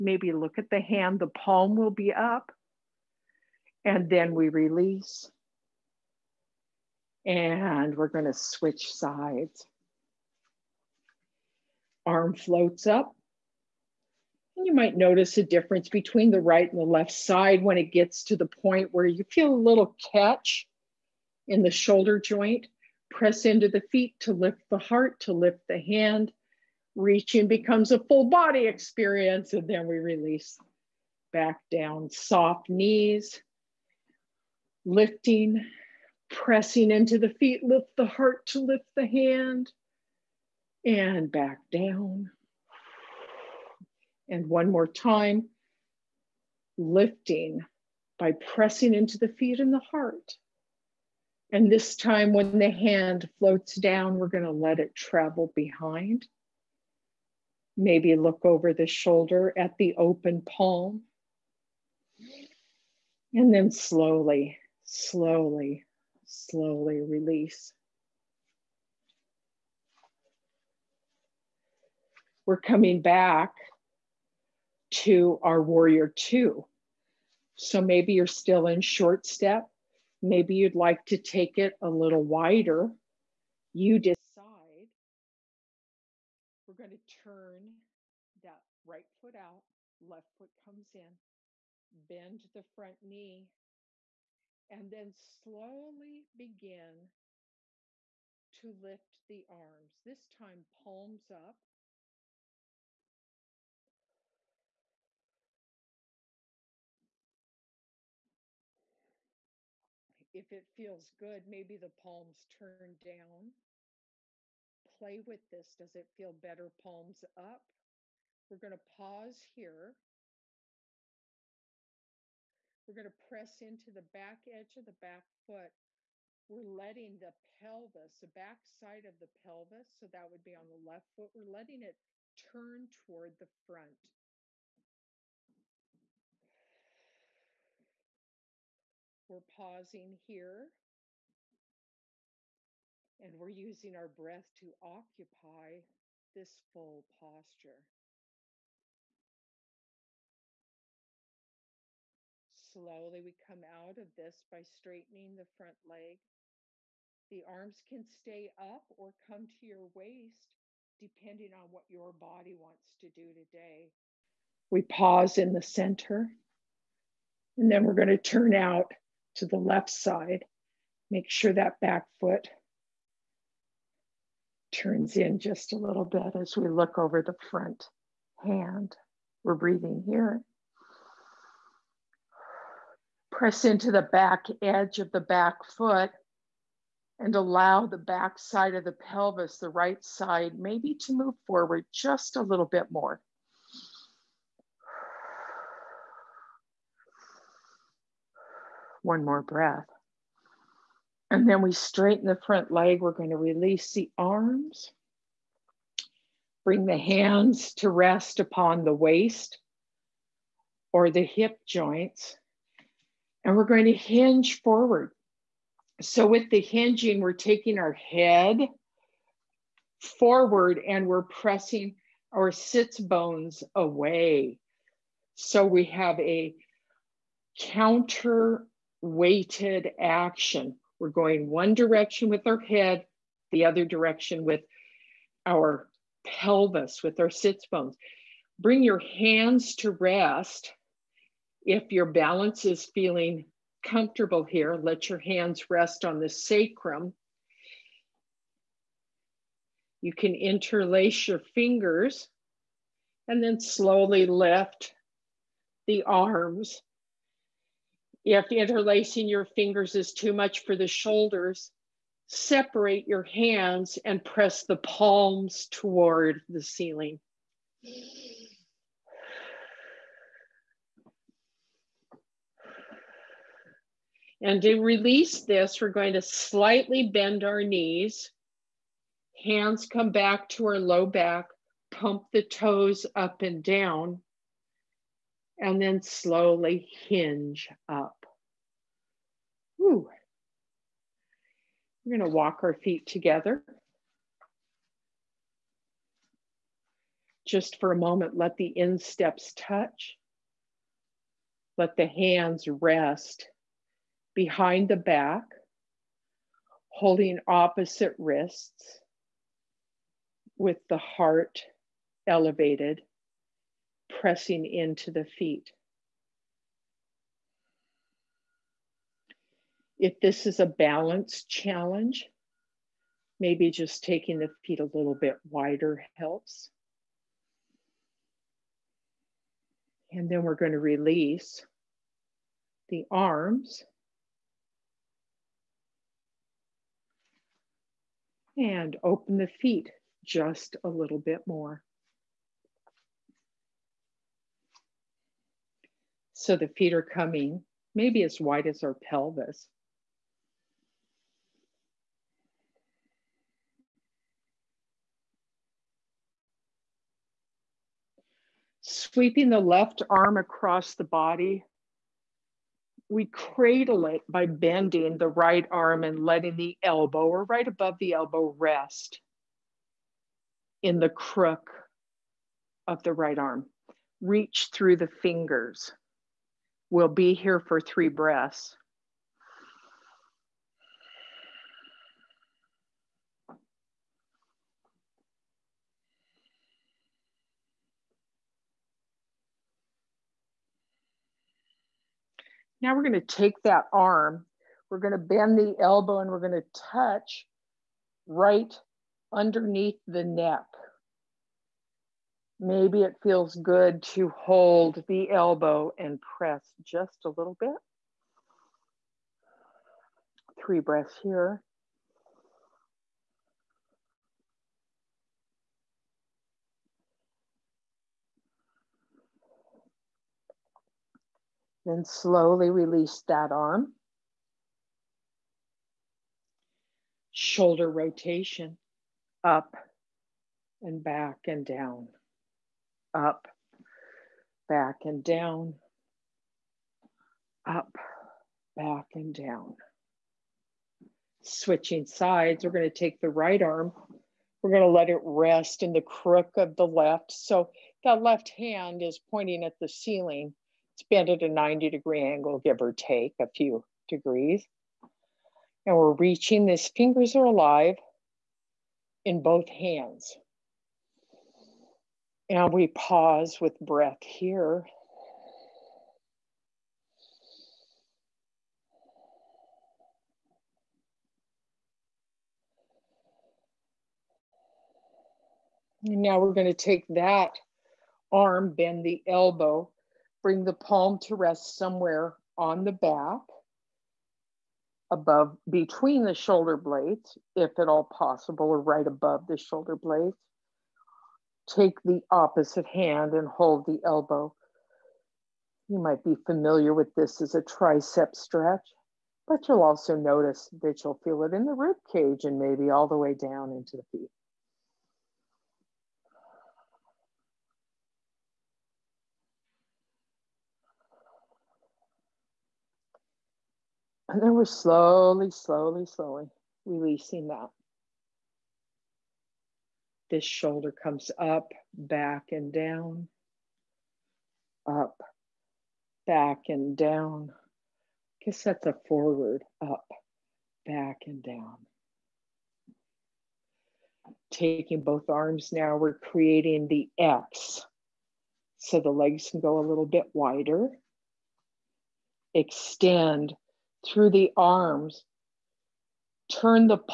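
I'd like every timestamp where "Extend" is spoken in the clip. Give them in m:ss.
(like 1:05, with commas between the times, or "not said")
9:02.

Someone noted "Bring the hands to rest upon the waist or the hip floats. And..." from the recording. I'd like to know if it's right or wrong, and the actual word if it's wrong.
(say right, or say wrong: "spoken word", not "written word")
wrong: "joints", not "floats".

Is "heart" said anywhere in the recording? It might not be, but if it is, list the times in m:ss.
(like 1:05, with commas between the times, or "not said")
0:24, 0:38, 0:49, 5:10.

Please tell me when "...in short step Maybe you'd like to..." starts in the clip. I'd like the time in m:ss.
1:18.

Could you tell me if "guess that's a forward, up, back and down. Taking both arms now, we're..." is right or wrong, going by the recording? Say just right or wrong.
right.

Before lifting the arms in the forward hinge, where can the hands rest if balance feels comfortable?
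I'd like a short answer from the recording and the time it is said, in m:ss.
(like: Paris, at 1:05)
the sacrum, at 4:06.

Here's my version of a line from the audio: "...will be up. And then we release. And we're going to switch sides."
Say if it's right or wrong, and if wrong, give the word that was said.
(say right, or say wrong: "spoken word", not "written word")
right.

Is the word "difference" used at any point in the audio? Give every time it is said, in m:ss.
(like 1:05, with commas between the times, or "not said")
0:15.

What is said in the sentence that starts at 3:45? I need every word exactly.
So, we have a counter weighted action.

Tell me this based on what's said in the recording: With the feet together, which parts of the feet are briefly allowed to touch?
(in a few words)
insteps.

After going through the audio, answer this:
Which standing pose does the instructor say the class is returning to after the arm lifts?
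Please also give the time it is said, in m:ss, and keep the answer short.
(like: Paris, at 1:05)
warrior two, at 1:15.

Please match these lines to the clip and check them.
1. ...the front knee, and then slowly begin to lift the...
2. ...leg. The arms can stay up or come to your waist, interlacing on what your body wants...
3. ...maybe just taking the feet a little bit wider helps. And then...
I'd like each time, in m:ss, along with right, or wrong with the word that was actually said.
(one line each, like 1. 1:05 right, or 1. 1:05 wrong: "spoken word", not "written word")
1. 1:32 right
2. 2:35 wrong: "depending", not "interlacing"
3. 5:23 right.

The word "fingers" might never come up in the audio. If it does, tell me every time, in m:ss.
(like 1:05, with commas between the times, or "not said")
4:11, 4:19, 6:15, 7:36.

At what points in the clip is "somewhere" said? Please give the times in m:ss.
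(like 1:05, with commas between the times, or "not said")
8:01.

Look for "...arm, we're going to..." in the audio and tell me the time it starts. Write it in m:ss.
6:33.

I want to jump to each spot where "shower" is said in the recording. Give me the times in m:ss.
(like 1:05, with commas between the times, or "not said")
not said.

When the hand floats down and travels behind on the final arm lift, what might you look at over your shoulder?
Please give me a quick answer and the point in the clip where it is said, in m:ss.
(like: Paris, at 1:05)
the open palm, at 0:59.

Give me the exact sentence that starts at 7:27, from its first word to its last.
So that left hand is pointing at the ceiling.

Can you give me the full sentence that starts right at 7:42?
And we pause with breath here.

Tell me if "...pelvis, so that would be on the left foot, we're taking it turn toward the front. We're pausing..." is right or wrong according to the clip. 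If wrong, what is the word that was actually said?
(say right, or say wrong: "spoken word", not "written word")
wrong: "letting", not "taking".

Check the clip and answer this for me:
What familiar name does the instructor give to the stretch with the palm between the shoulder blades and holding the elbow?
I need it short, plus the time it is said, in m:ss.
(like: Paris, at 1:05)
tricep stretch, at 8:17.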